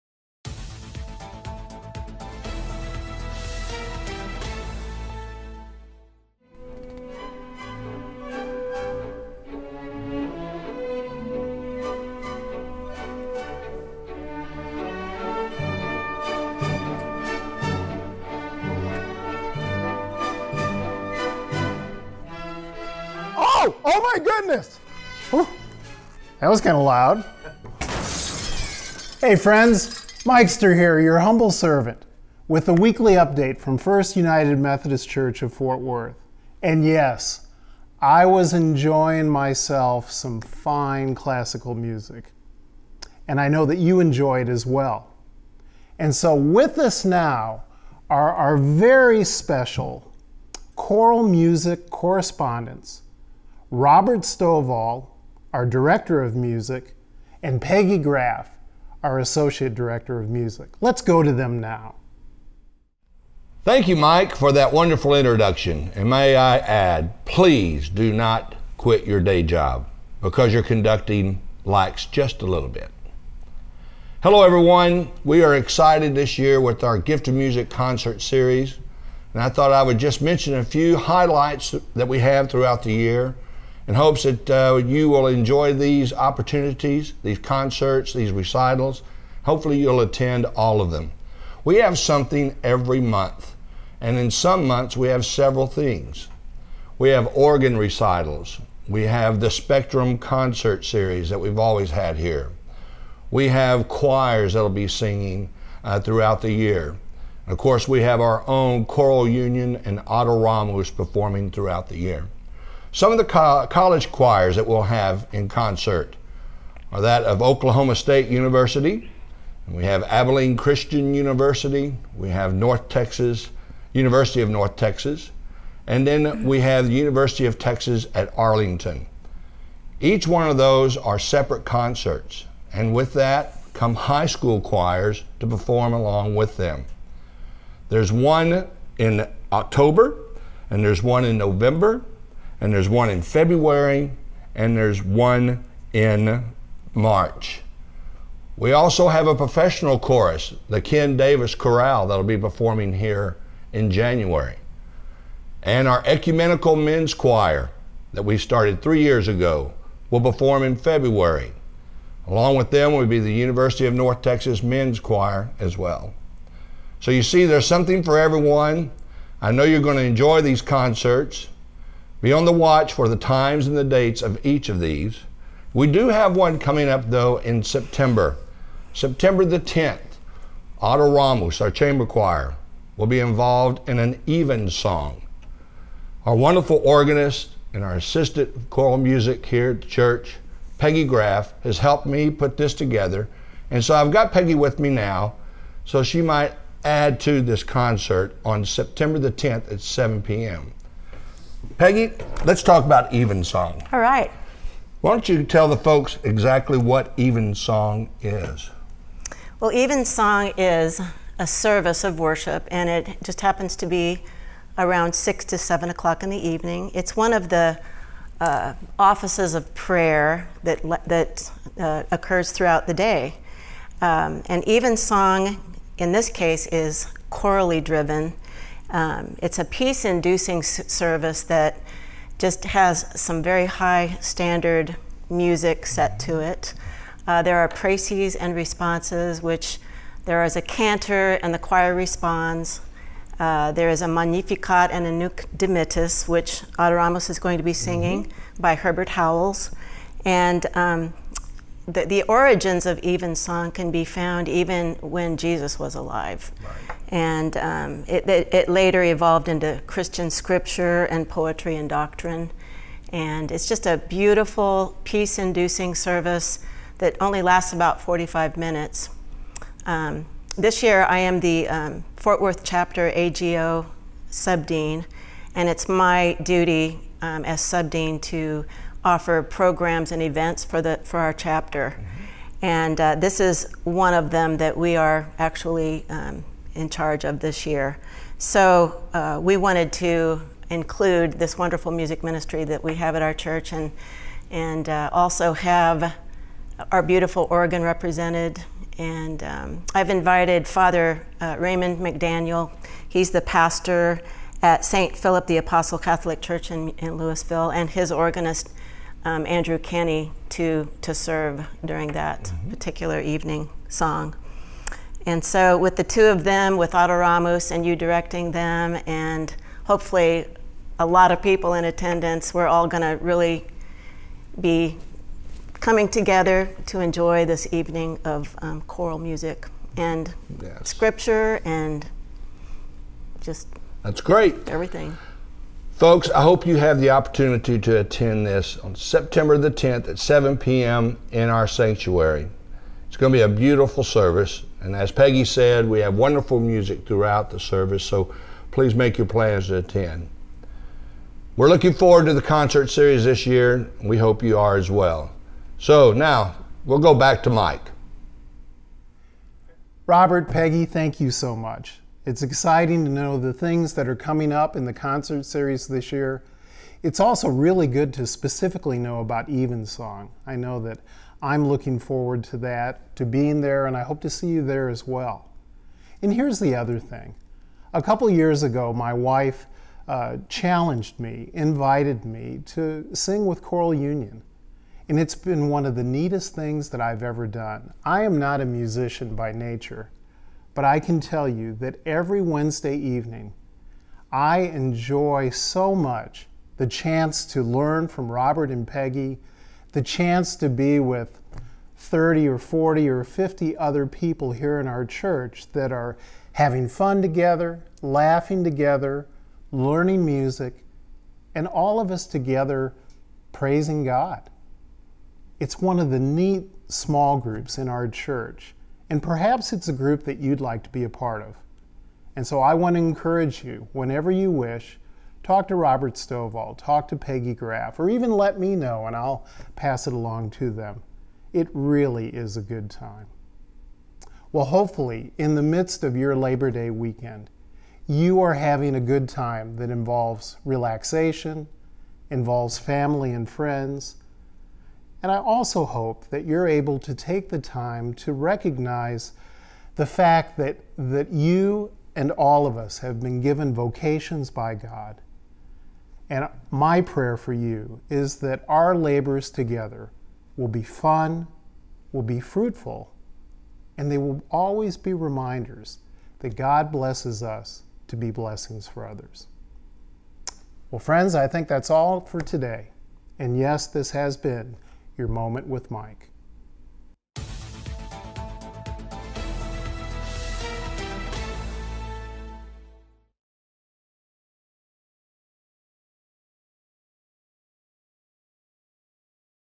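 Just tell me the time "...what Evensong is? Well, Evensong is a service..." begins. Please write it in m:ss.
3:26.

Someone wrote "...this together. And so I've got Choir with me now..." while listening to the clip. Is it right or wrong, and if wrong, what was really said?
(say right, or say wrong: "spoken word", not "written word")
wrong: "Peggy", not "Choir".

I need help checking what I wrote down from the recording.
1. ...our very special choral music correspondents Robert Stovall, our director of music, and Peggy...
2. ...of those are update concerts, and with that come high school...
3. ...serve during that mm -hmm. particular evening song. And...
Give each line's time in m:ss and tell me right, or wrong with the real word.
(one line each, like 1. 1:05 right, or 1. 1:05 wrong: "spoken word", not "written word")
1. 0:48 right
2. 2:10 wrong: "separate", not "update"
3. 5:11 right.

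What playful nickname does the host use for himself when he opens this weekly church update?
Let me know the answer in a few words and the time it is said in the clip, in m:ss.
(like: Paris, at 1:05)
Mikester, at 0:30.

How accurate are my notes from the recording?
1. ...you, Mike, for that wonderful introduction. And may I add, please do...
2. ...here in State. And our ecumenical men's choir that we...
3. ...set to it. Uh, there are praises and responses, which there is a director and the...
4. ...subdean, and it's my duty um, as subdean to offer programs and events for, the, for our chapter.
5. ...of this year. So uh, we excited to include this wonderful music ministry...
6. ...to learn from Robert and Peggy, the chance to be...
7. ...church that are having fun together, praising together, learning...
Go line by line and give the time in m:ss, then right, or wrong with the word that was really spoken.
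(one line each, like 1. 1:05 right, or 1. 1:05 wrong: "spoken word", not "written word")
1. 1:03 right
2. 2:32 wrong: "January", not "State"
3. 3:55 wrong: "cantor", not "director"
4. 4:34 right
5. 4:47 wrong: "wanted", not "excited"
6. 6:37 right
7. 6:45 wrong: "laughing", not "praising".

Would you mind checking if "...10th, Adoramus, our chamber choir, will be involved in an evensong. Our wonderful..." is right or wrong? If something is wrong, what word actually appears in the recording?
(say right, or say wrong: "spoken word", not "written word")
right.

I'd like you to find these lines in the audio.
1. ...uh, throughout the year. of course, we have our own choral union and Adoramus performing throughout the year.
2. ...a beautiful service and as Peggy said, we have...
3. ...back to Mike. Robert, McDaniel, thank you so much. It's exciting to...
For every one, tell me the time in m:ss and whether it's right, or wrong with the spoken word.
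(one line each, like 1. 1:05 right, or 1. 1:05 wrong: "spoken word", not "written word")
1. 1:45 right
2. 5:43 right
3. 5:57 wrong: "Peggy", not "McDaniel".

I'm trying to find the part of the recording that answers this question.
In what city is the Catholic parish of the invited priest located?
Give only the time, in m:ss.
5:07.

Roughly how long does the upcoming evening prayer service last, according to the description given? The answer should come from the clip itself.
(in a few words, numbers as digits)
45 minutes.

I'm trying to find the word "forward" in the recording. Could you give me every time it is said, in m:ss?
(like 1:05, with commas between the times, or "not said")
5:51, 6:11.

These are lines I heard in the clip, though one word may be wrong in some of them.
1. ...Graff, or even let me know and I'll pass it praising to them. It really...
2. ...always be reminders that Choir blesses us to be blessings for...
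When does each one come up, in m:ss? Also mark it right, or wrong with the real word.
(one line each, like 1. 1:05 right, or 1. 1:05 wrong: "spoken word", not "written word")
1. 7:07 wrong: "along", not "praising"
2. 7:44 wrong: "God", not "Choir".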